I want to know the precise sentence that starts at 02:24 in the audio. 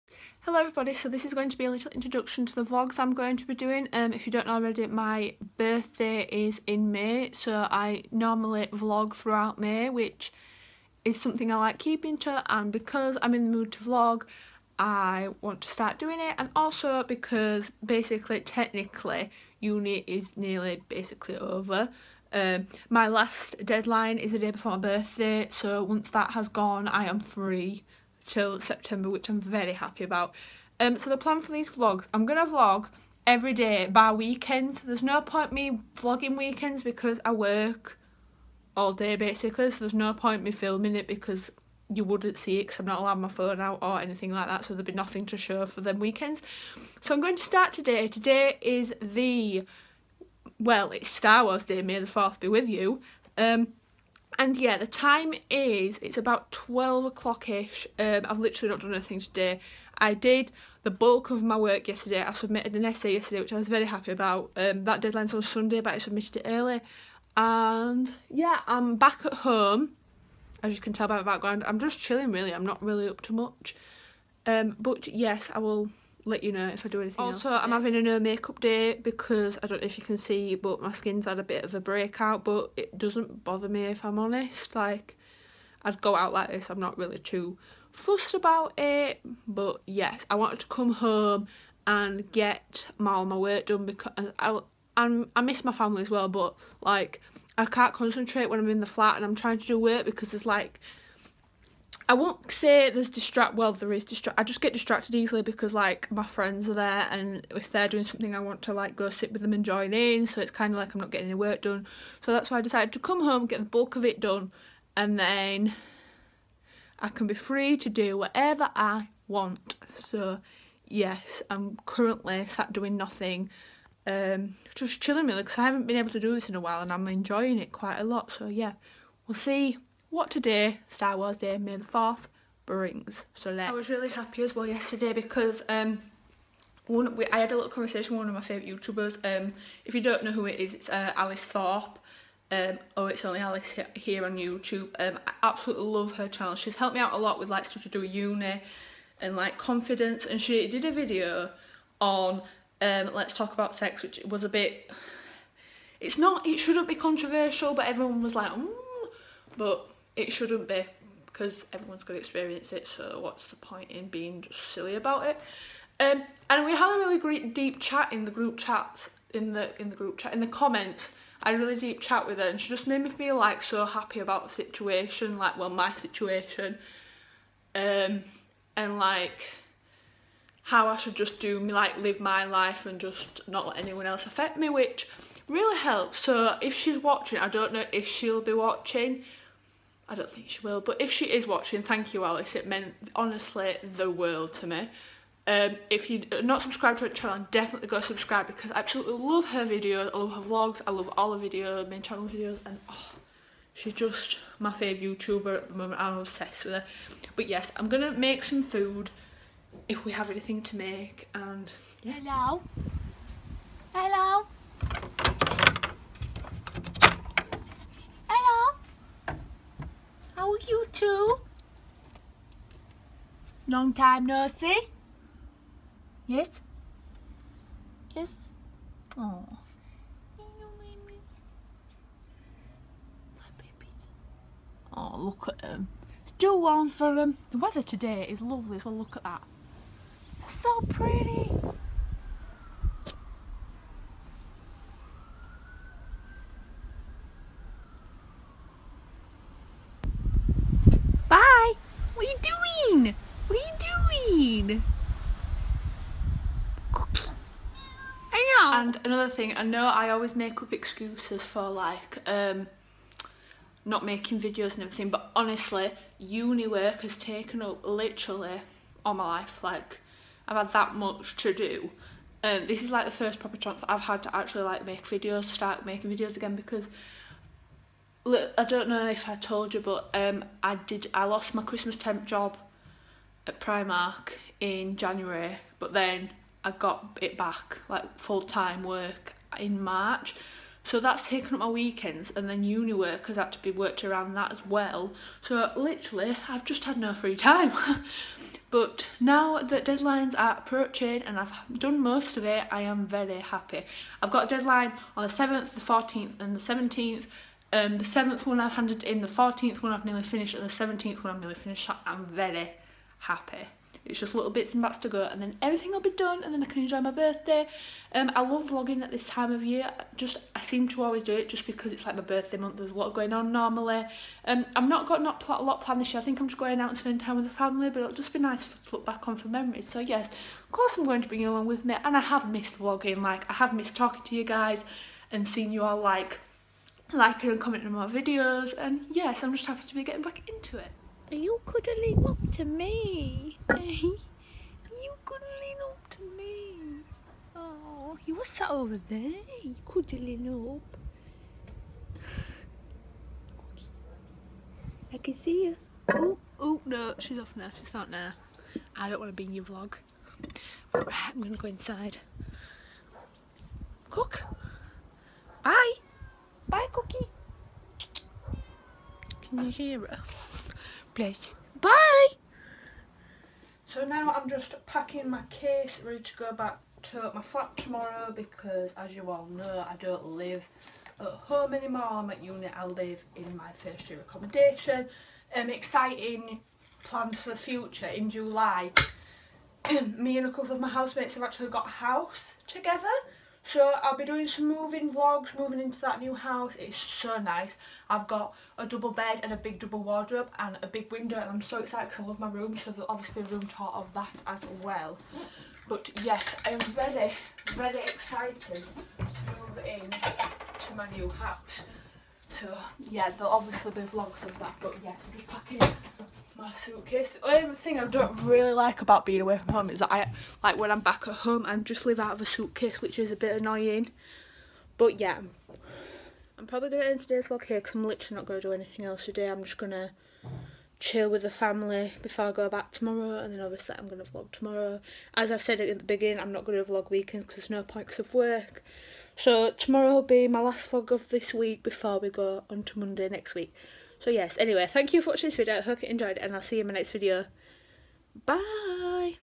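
Um, I absolutely love her channel.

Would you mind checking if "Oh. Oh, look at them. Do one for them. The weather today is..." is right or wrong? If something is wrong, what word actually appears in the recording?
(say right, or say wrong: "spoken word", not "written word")
right.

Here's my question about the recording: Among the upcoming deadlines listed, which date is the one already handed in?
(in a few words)
7th.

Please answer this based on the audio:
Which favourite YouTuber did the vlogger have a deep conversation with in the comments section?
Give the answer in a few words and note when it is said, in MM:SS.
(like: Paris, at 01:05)
Alice Thorpe, at 02:21.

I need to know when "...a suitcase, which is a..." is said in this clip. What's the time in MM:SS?
07:02.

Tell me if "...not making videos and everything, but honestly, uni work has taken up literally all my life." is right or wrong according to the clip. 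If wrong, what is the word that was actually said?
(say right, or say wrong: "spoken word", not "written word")
right.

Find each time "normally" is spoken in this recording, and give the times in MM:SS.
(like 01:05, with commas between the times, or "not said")
00:08, 05:23.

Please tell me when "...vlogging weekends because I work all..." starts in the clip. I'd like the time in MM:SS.
00:35.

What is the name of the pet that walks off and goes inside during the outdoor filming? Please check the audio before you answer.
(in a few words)
Cookie.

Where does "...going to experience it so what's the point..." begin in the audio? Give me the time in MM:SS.
02:42.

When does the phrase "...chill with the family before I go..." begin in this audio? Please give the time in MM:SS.
07:10.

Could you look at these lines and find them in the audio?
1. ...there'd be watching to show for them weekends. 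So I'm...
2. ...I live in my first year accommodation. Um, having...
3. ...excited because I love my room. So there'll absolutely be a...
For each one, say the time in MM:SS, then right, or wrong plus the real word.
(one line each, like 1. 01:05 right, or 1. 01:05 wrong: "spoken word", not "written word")
1. 00:44 wrong: "nothing", not "watching"
2. 06:22 wrong: "exciting", not "having"
3. 06:41 wrong: "obviously", not "absolutely".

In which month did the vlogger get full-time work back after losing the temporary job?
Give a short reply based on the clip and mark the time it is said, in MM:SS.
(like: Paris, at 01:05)
March, at 04:49.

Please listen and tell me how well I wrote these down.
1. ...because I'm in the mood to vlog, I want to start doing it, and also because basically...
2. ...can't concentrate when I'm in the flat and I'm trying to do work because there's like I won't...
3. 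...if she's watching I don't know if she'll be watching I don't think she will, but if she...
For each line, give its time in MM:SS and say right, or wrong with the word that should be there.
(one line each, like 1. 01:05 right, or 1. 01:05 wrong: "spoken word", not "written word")
1. 00:12 right
2. 01:37 right
3. 03:06 right.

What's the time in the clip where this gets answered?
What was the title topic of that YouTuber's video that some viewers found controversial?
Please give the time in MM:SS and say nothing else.
02:33.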